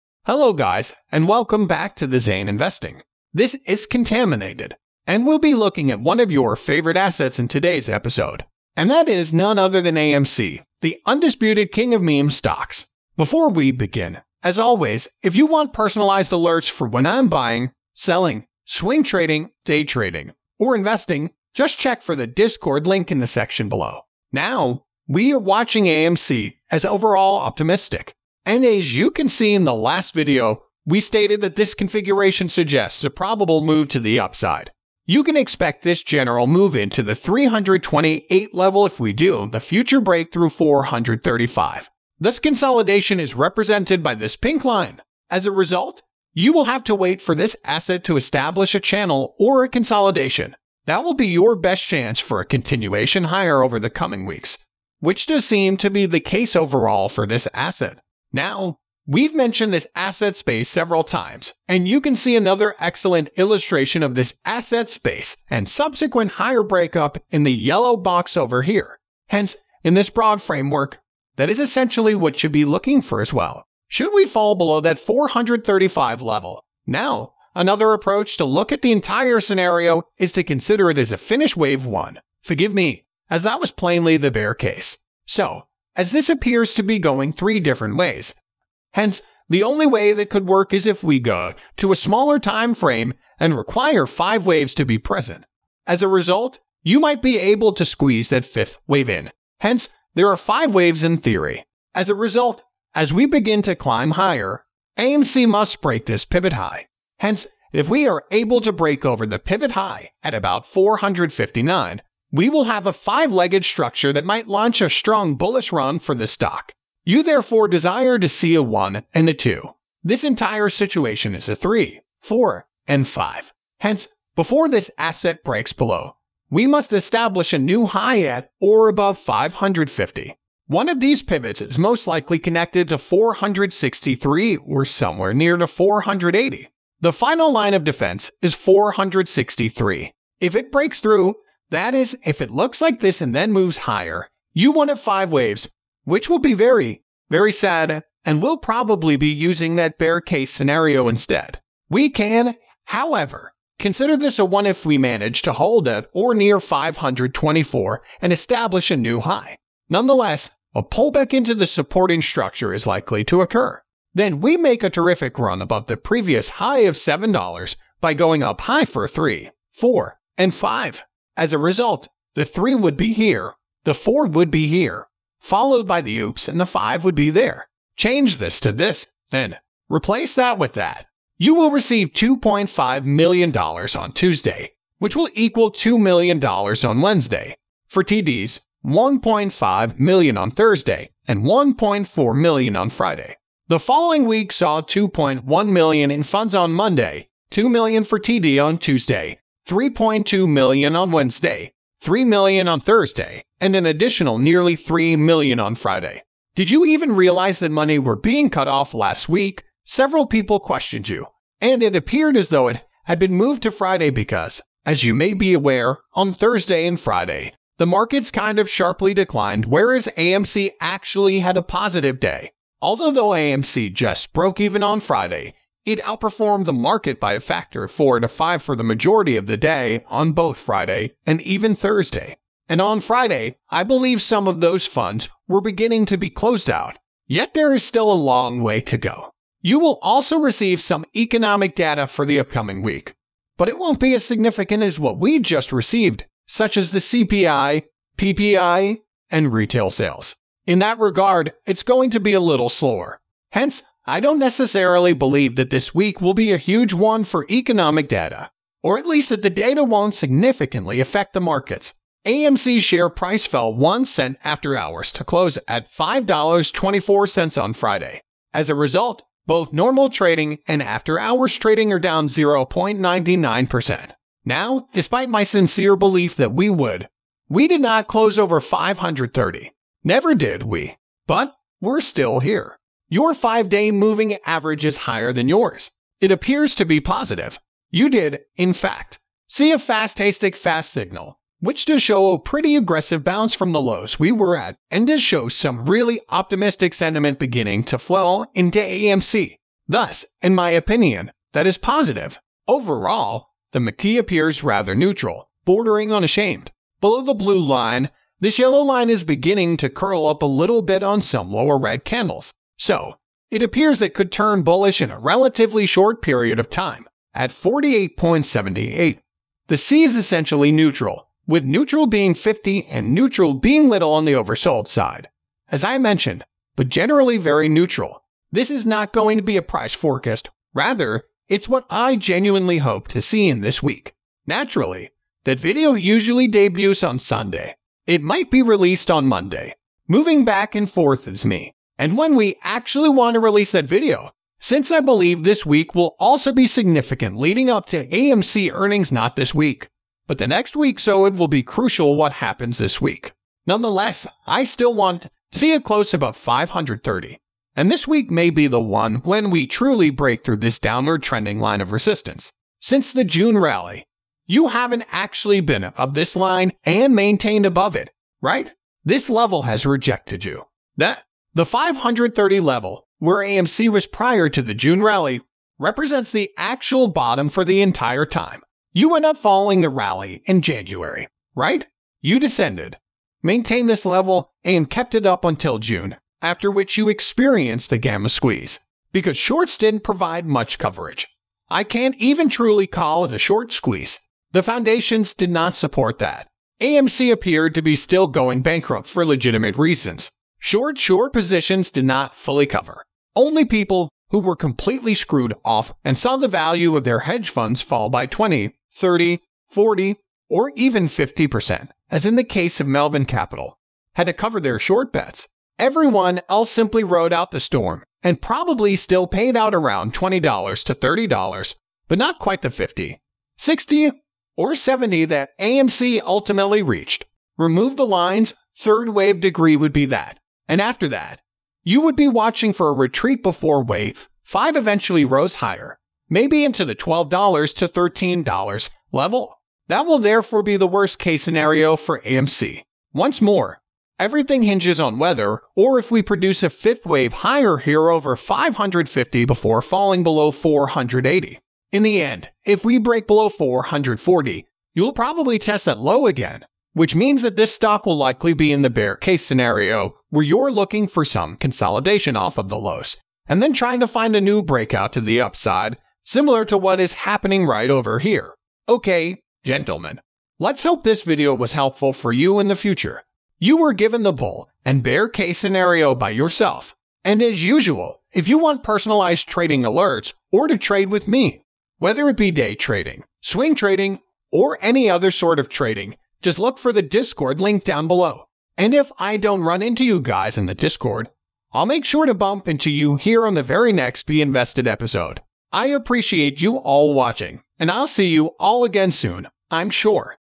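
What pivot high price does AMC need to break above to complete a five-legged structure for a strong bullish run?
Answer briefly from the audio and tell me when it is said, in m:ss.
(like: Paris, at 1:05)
459, at 1:50.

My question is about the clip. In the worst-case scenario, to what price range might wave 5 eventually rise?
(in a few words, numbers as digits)
$12 to $13.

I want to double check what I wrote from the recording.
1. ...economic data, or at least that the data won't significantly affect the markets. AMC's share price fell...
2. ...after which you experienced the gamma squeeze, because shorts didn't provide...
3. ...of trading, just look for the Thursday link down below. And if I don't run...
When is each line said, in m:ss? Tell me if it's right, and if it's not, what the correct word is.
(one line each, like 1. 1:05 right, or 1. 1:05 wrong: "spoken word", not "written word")
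1. 4:17 right
2. 6:26 right
3. 8:05 wrong: "Discord", not "Thursday".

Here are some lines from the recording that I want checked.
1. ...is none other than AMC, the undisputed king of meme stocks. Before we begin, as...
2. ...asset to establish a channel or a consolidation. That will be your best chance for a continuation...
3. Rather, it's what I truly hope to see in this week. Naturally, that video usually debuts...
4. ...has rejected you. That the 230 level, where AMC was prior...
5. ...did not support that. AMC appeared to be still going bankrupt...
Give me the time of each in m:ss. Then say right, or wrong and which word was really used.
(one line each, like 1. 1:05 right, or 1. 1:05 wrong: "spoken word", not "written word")
1. 0:09 right
2. 0:47 right
3. 5:30 wrong: "genuinely", not "truly"
4. 6:09 wrong: "530", not "230"
5. 6:35 right.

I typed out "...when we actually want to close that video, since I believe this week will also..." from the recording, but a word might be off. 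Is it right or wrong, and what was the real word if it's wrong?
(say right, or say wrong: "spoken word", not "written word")
wrong: "release", not "close".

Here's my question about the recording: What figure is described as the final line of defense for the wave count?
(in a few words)
463.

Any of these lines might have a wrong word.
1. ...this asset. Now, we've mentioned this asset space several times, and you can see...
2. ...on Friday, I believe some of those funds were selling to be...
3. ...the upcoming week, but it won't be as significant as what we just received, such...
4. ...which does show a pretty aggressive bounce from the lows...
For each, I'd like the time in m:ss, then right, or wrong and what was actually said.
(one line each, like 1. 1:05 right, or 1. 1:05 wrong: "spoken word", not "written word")
1. 0:57 right
2. 3:52 wrong: "beginning", not "selling"
3. 4:02 right
4. 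4:51 right.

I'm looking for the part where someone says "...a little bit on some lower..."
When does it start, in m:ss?
5:10.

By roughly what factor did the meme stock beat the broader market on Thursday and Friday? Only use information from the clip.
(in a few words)
4 to 5.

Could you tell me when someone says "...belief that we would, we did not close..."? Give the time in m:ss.
4:35.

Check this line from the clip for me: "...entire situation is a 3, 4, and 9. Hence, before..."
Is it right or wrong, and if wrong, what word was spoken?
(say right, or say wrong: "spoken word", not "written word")
wrong: "5", not "9".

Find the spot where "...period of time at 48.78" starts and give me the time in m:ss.
5:16.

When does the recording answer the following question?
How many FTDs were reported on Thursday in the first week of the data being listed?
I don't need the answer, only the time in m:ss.
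3:08.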